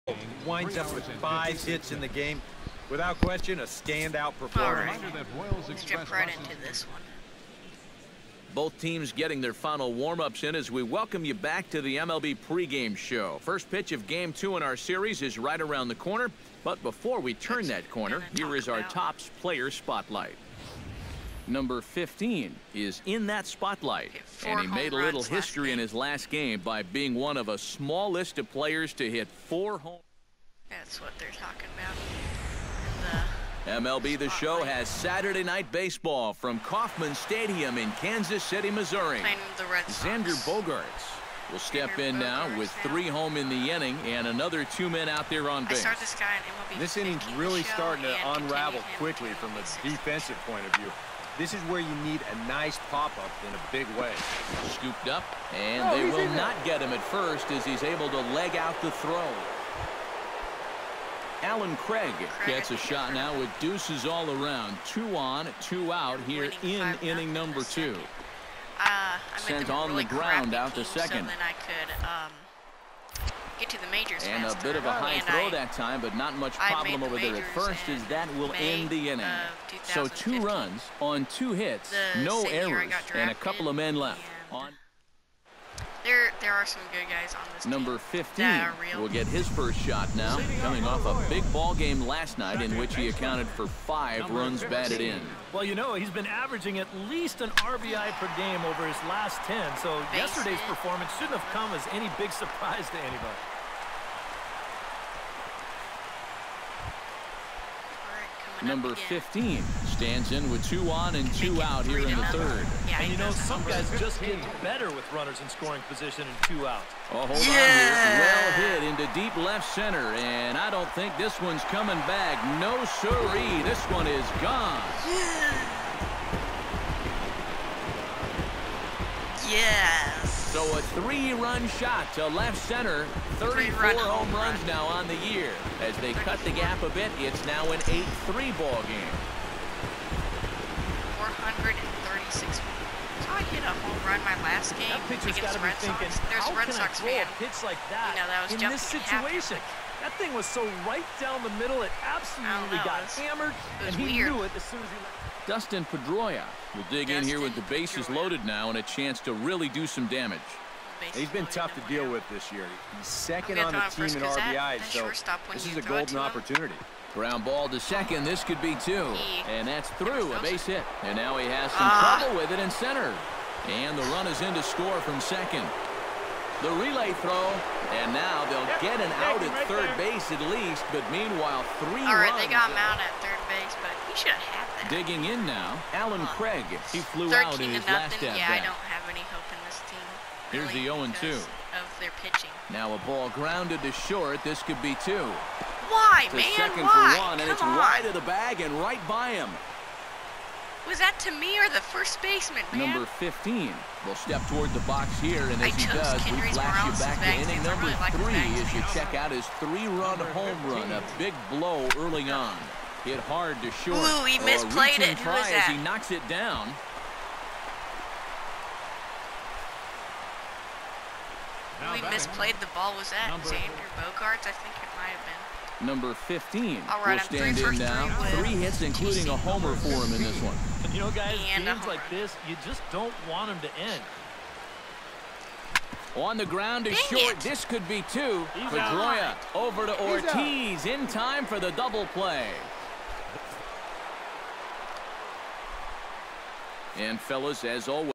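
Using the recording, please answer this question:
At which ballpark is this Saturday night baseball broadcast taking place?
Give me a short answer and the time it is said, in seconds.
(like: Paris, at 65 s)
Kauffman Stadium, at 36 s.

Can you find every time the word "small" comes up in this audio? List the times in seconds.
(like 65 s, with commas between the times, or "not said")
27 s.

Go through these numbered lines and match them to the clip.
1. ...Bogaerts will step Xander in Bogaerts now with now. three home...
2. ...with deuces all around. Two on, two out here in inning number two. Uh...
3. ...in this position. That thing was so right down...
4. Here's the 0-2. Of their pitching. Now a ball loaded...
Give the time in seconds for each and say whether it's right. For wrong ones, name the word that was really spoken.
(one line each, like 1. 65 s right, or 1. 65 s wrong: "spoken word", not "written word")
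1. 40 s right
2. 63 s right
3. 148 s wrong: "situation", not "position"
4. 190 s wrong: "grounded", not "loaded".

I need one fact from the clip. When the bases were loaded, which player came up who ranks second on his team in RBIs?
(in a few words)
Dustin Pedroia.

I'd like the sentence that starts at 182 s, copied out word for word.
they got him out at third base, but he should have had that.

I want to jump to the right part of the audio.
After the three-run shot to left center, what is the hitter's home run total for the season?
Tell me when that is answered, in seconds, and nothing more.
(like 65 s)
133 s.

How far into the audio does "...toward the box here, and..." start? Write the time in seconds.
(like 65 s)
204 s.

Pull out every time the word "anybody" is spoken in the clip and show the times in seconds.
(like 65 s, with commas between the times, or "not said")
102 s.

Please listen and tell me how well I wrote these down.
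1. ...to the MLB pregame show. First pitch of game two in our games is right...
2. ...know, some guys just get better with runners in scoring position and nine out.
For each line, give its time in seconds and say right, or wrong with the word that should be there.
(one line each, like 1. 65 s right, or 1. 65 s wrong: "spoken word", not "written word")
1. 11 s wrong: "series", not "games"
2. 113 s wrong: "two", not "nine".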